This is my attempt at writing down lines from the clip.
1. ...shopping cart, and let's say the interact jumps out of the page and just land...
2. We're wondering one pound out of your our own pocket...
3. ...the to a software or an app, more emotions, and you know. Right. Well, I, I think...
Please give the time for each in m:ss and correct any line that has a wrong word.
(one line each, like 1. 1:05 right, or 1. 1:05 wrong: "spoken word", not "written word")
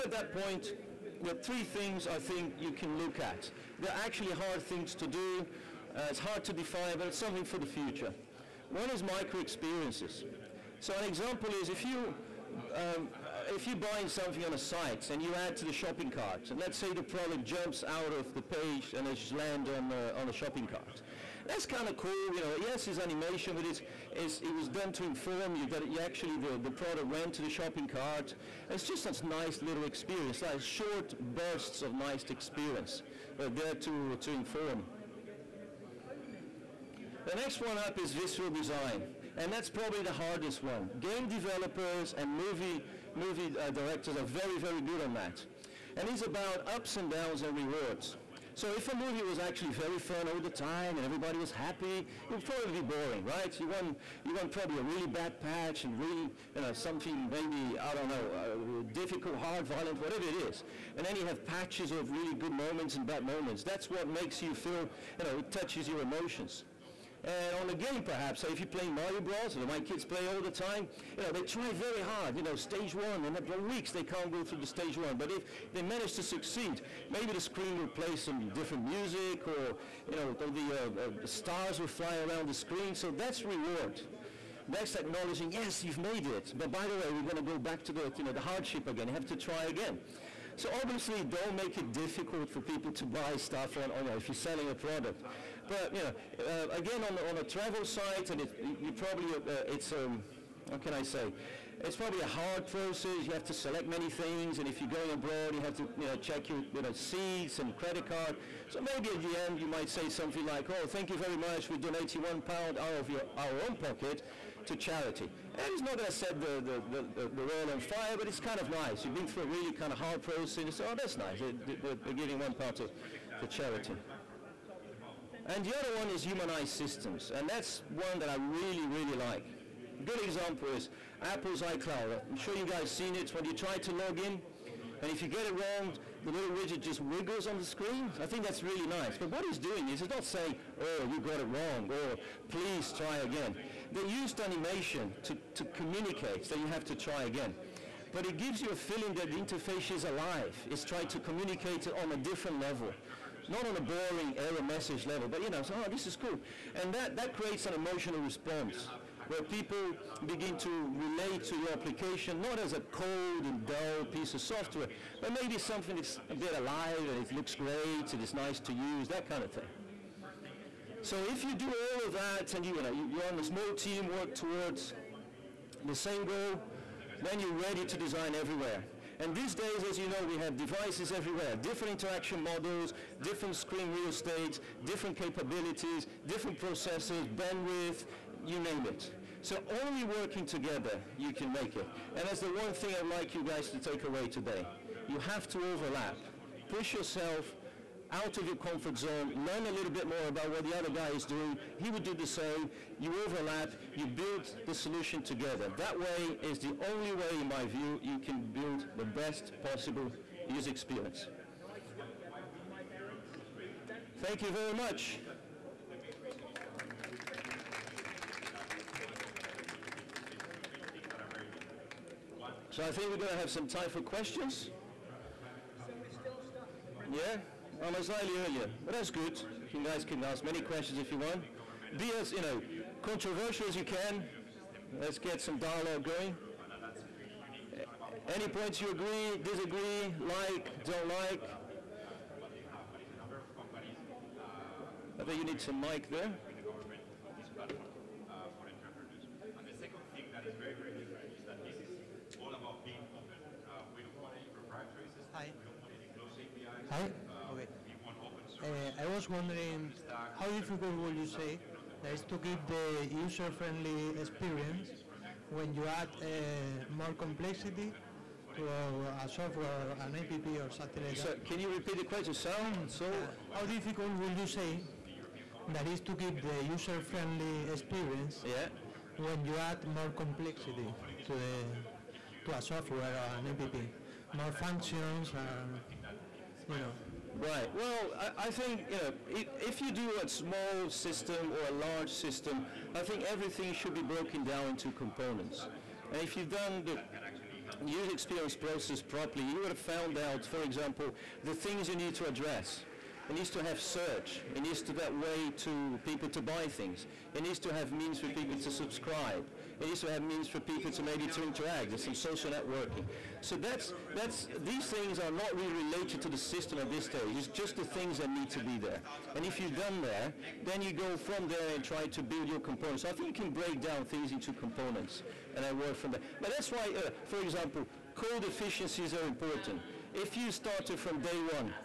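1. 0:15 wrong: "product", not "interact"
2. 1:51 wrong: "donating", not "wondering"
3. 4:41 wrong: "functions", not "emotions".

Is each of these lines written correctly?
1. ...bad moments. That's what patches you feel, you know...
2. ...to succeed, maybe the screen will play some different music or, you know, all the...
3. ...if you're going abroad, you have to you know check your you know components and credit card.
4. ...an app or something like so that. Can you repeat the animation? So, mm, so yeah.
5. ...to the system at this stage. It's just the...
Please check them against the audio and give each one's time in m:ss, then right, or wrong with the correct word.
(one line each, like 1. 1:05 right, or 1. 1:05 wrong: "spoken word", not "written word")
1. 1:03 wrong: "makes", not "patches"
2. 1:16 right
3. 1:44 wrong: "seats", not "components"
4. 4:30 wrong: "question", not "animation"
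5. 5:16 right.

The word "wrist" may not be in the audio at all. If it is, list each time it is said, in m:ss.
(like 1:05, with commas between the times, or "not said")
not said.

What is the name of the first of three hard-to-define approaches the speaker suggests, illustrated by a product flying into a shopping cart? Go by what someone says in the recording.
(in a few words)
Micro experiences.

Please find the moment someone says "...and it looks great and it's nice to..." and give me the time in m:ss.
2:47.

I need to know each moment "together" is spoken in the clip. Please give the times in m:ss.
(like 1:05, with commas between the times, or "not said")
3:10, 3:25.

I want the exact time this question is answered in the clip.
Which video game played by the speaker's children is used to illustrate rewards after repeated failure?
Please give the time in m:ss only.
1:08.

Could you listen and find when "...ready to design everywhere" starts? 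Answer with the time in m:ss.
2:57.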